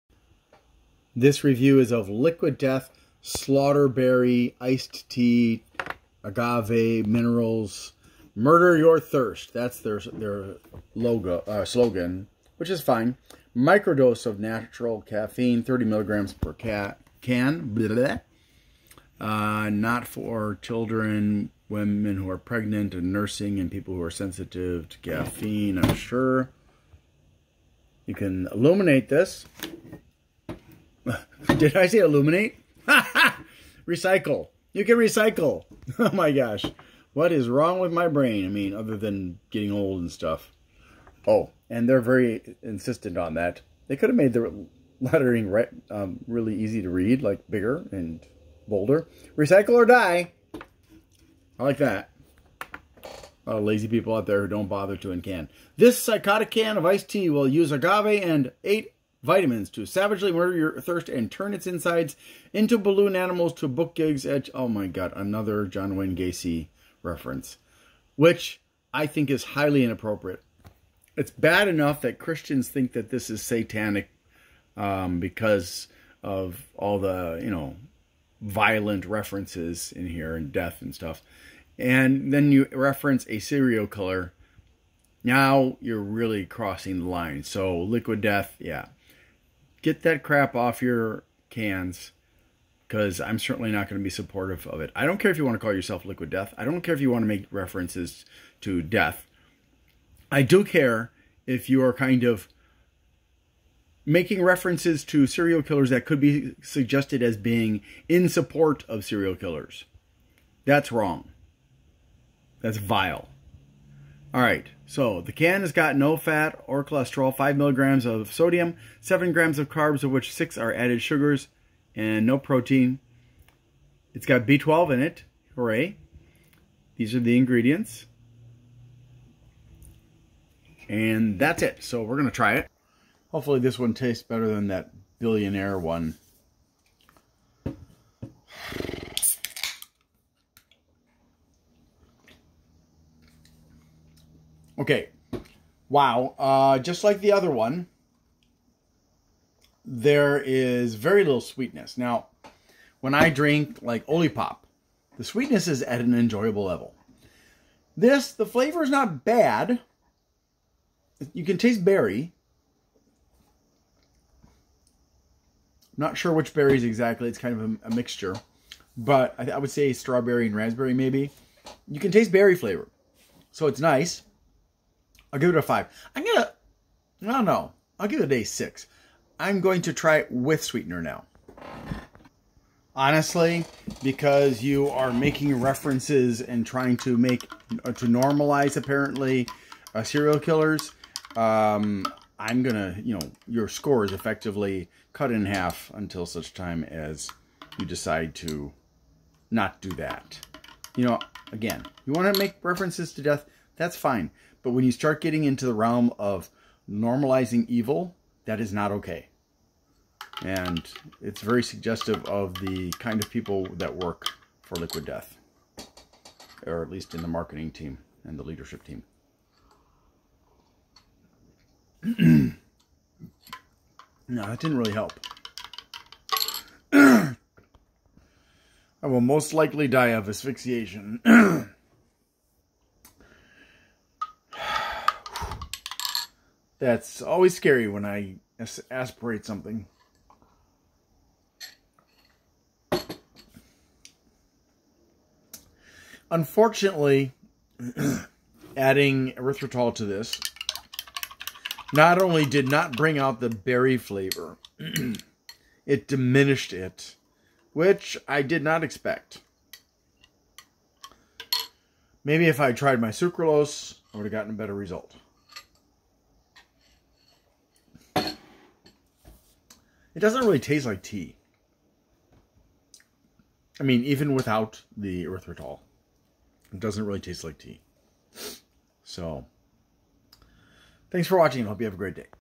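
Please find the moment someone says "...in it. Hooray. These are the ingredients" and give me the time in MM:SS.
02:04.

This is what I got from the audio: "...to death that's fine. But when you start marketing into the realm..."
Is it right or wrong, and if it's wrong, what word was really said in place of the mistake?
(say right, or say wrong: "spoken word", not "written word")
wrong: "getting", not "marketing".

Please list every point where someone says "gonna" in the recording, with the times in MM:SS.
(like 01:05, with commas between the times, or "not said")
02:56, 03:12.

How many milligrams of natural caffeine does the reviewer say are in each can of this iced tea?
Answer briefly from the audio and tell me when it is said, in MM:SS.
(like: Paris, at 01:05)
30, at 00:15.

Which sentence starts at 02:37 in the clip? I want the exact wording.
This, the flavor is not bad.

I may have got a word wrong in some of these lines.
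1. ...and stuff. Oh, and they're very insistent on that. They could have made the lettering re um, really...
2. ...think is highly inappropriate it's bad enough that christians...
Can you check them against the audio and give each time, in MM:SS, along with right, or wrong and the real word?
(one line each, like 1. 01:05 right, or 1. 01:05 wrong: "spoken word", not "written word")
1. 00:39 right
2. 01:09 right.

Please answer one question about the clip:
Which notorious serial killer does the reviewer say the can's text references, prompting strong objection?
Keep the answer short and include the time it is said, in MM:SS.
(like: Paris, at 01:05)
John Wayne Gacy, at 01:05.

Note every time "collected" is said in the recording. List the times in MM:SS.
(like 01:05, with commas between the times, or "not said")
not said.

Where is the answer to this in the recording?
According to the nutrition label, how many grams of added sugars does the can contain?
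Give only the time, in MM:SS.
02:00.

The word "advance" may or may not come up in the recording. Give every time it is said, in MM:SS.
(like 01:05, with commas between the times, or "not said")
not said.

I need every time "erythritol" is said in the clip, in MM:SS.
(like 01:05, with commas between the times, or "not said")
04:09, 04:35.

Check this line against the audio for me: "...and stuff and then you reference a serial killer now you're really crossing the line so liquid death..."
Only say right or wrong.
right.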